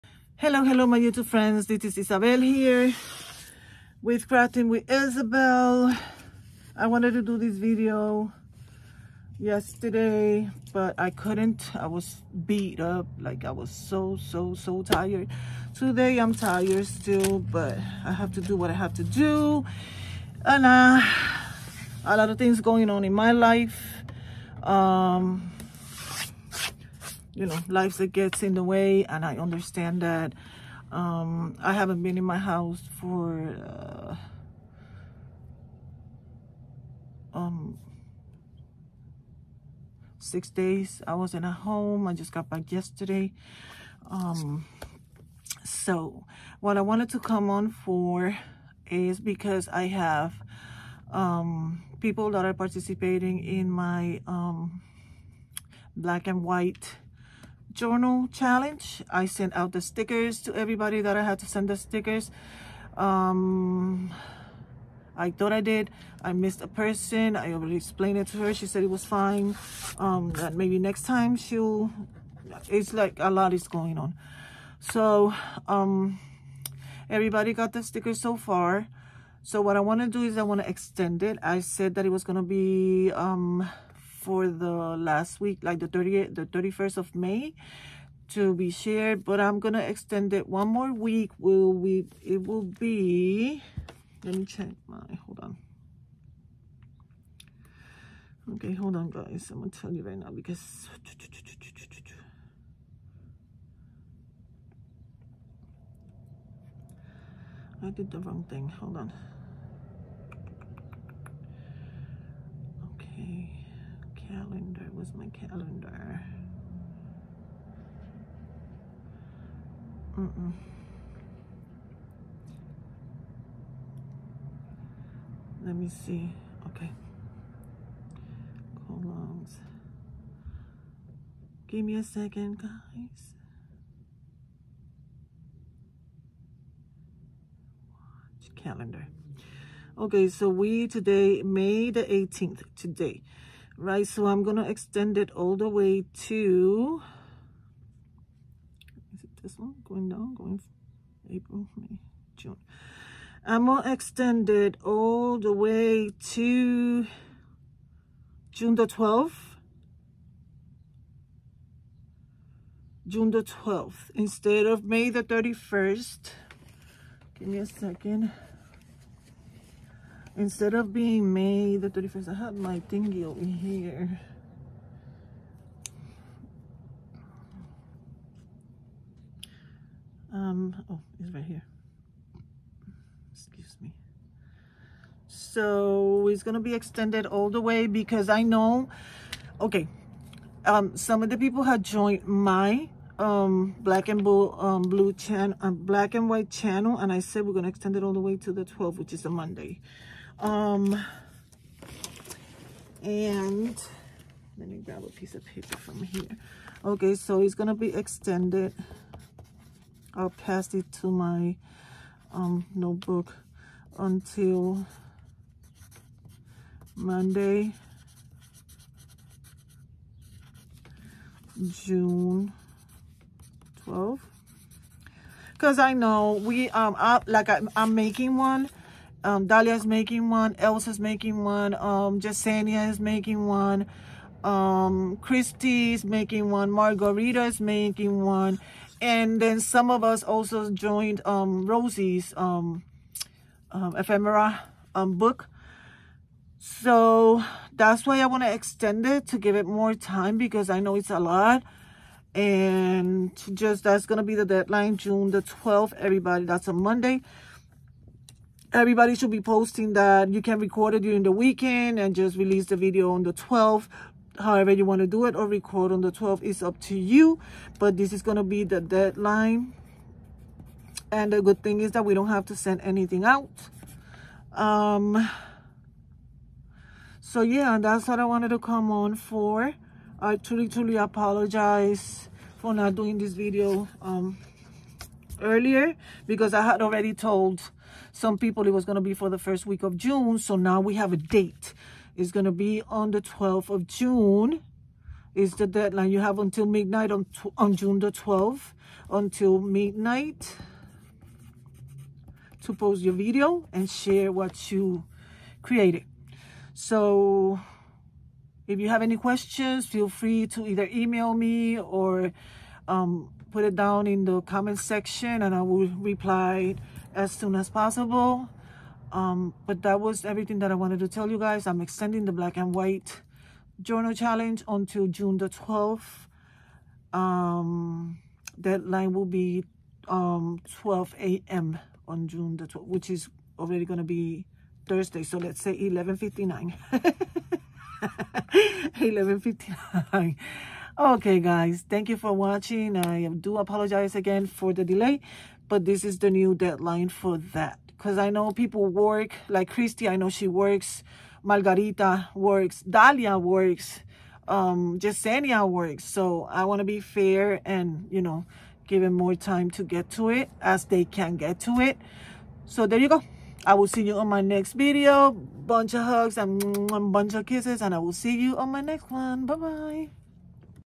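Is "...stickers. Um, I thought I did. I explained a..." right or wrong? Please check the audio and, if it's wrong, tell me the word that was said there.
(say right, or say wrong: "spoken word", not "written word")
wrong: "missed", not "explained".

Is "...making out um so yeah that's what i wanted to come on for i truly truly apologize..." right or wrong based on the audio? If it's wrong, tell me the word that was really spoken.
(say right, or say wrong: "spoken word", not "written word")
wrong: "anything", not "making".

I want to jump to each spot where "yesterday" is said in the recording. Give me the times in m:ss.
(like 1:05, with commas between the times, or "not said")
0:09, 0:42.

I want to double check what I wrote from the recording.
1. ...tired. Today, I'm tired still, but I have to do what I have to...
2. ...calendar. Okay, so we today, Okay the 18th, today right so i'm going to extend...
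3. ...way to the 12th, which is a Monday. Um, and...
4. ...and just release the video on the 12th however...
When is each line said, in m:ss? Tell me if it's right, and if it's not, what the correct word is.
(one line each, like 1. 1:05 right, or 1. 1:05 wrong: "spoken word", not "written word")
1. 0:14 right
2. 2:18 wrong: "May", not "Okay"
3. 3:18 right
4. 4:21 right.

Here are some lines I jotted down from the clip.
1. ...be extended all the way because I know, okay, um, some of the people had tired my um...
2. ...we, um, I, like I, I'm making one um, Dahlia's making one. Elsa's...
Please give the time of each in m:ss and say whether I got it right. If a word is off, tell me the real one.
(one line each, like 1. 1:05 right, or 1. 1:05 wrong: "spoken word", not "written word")
1. 3:06 wrong: "joined", not "tired"
2. 3:46 right.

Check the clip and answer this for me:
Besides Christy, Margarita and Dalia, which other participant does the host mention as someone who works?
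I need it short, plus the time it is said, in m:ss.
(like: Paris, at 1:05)
Yesenia, at 5:54.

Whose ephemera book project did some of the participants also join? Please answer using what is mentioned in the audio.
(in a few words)
Rosie.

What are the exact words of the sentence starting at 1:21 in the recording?
I said that it was going to be...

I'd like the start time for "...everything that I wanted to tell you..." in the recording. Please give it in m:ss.
5:20.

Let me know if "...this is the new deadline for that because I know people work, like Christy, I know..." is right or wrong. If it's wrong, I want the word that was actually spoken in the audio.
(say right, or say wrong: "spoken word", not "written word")
right.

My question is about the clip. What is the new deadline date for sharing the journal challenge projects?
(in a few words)
June 12.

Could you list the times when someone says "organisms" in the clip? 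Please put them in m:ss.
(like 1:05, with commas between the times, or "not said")
not said.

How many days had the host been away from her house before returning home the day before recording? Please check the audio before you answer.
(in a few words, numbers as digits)
6.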